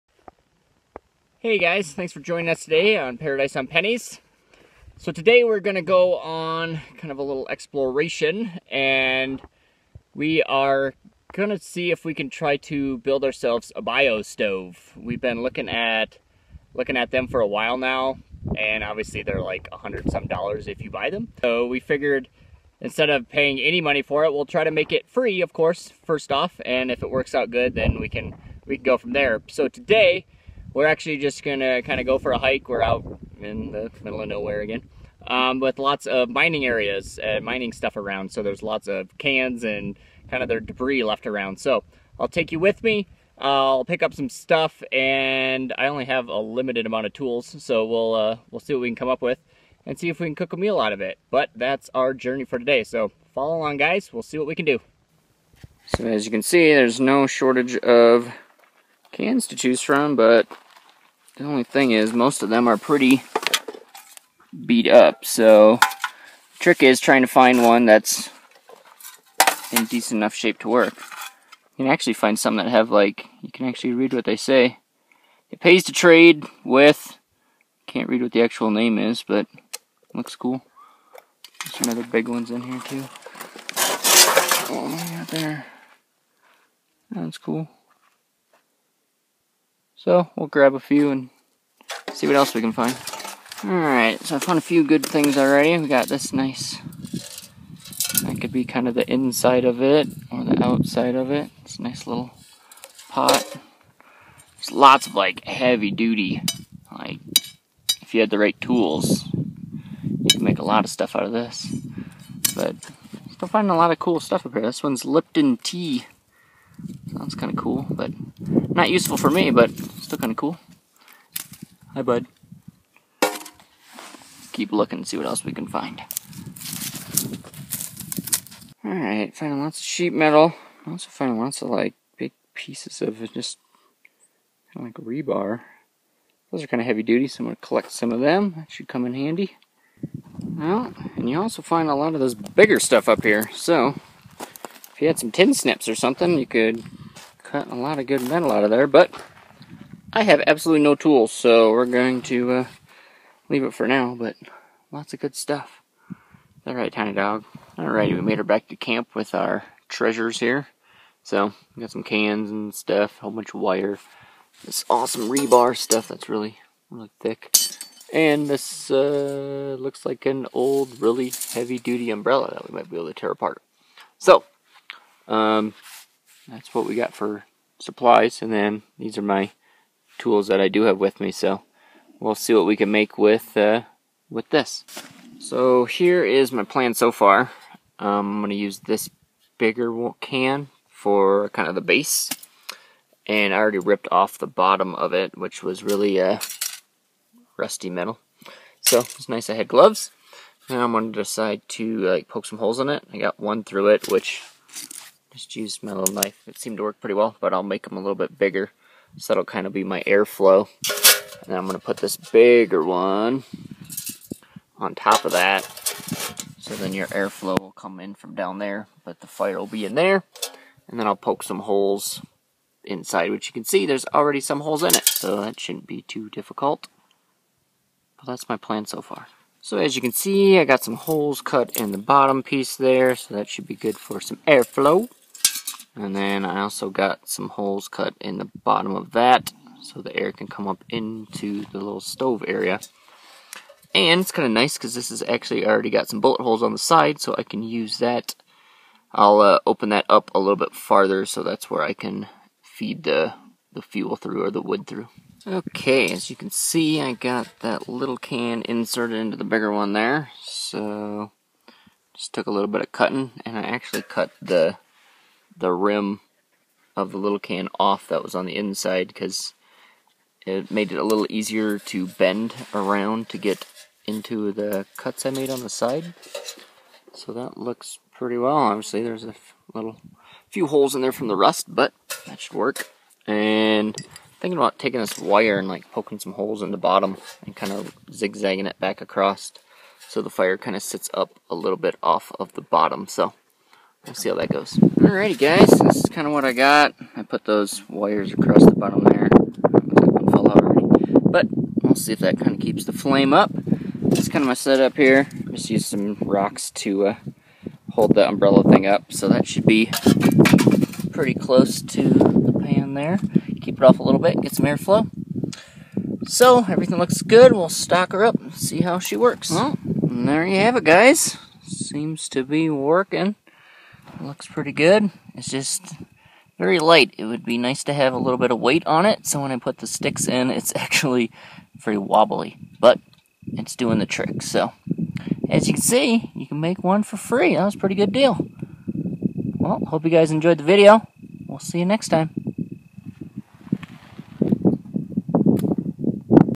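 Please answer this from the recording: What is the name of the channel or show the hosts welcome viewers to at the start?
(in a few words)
Paradise on Pennies.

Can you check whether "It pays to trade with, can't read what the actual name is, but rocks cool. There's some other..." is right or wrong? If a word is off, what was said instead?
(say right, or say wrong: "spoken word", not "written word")
wrong: "looks", not "rocks".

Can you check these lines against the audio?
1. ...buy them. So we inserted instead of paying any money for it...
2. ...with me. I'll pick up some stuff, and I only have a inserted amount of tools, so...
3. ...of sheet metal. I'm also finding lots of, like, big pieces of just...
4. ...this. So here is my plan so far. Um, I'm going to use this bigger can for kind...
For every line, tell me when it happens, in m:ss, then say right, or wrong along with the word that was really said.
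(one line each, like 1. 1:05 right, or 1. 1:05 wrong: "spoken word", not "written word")
1. 0:20 wrong: "figured", not "inserted"
2. 0:42 wrong: "limited", not "inserted"
3. 2:09 right
4. 3:04 right.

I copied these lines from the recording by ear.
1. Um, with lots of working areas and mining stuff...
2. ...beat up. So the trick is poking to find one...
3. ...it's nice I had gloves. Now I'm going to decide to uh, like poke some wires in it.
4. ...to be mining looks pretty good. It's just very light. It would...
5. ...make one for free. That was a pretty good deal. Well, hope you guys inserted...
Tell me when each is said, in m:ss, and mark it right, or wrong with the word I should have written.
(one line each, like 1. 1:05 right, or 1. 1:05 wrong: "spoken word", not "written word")
1. 0:35 wrong: "mining", not "working"
2. 1:04 wrong: "trying", not "poking"
3. 3:18 wrong: "holes", not "wires"
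4. 5:22 wrong: "working", not "mining"
5. 5:36 wrong: "enjoyed", not "inserted".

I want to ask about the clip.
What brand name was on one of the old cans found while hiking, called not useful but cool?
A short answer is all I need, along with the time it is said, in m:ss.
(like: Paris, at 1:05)
Lipton Tea, at 1:55.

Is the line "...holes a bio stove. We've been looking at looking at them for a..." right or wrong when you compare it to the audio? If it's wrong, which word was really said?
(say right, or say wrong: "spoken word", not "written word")
wrong: "ourselves", not "holes".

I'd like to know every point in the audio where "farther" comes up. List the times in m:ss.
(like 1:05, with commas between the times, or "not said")
4:10.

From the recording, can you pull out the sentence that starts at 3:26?
It seemed to work pretty well, but I'll make them a little bit bigger.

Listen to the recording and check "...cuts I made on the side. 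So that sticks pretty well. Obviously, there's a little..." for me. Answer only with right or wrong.
wrong.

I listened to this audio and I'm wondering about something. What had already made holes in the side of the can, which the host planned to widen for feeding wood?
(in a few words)
bullet holes.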